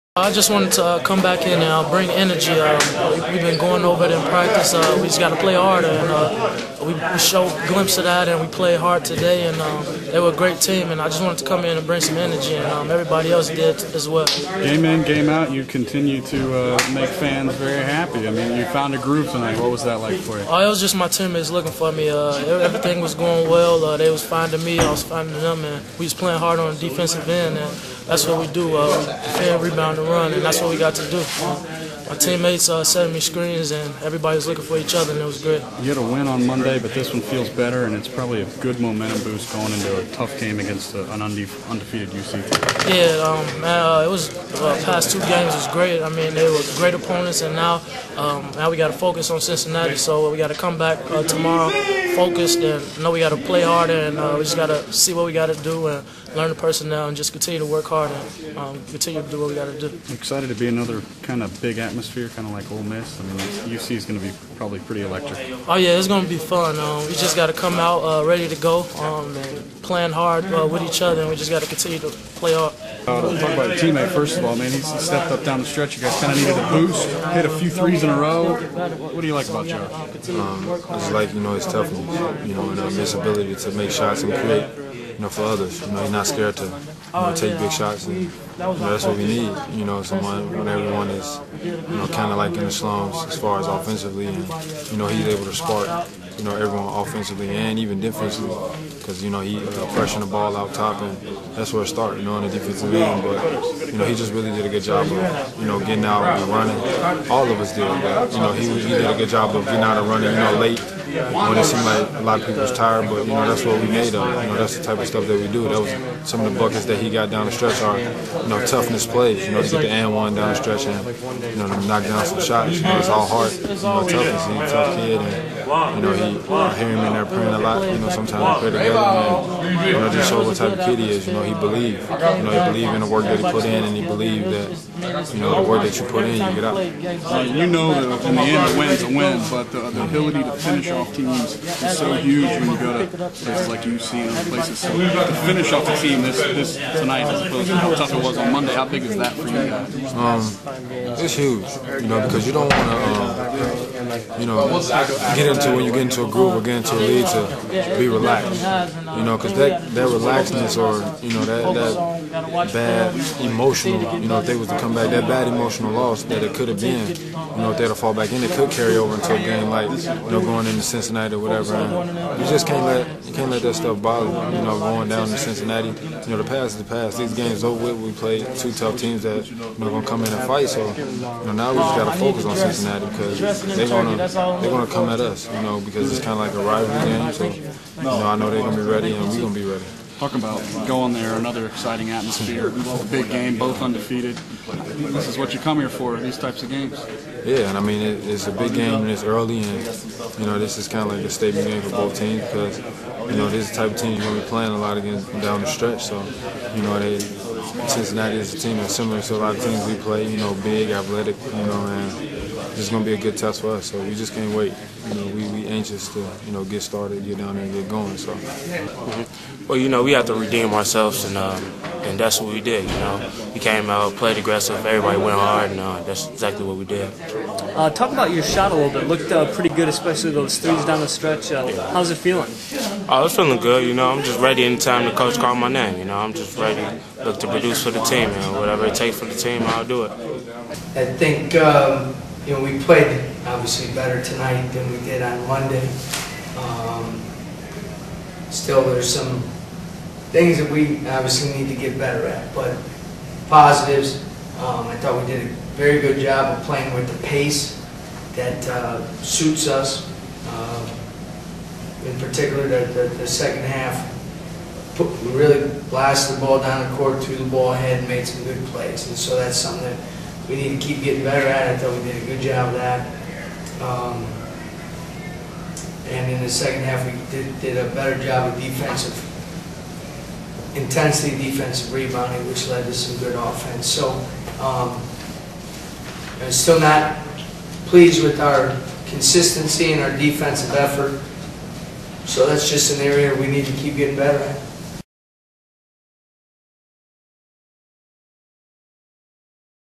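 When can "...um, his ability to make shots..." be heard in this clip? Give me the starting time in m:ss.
1:22.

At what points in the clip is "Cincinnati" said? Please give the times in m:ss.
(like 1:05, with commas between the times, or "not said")
0:49, 2:50, 2:55, 3:02, 3:27.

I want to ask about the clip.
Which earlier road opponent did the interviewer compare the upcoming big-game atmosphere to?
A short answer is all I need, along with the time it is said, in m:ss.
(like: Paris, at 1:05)
Ole Miss, at 1:02.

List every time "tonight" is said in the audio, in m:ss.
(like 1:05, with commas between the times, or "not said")
0:19, 2:26, 4:04.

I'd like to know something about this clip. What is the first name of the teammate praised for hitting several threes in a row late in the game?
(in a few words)
Joe.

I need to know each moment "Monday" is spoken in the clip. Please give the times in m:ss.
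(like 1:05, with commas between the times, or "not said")
0:36, 2:28, 4:05.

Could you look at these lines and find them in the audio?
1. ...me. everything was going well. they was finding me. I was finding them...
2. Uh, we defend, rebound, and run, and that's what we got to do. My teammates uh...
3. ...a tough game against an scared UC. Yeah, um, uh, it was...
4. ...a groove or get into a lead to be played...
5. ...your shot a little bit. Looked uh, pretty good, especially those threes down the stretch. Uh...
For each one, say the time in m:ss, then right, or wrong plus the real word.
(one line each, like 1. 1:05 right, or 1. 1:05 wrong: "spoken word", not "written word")
1. 0:21 right
2. 0:28 right
3. 0:40 wrong: "undefeated", not "scared"
4. 2:36 wrong: "relaxed", not "played"
5. 3:48 right.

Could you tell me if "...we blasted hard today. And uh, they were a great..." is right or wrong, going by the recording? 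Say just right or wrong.
wrong.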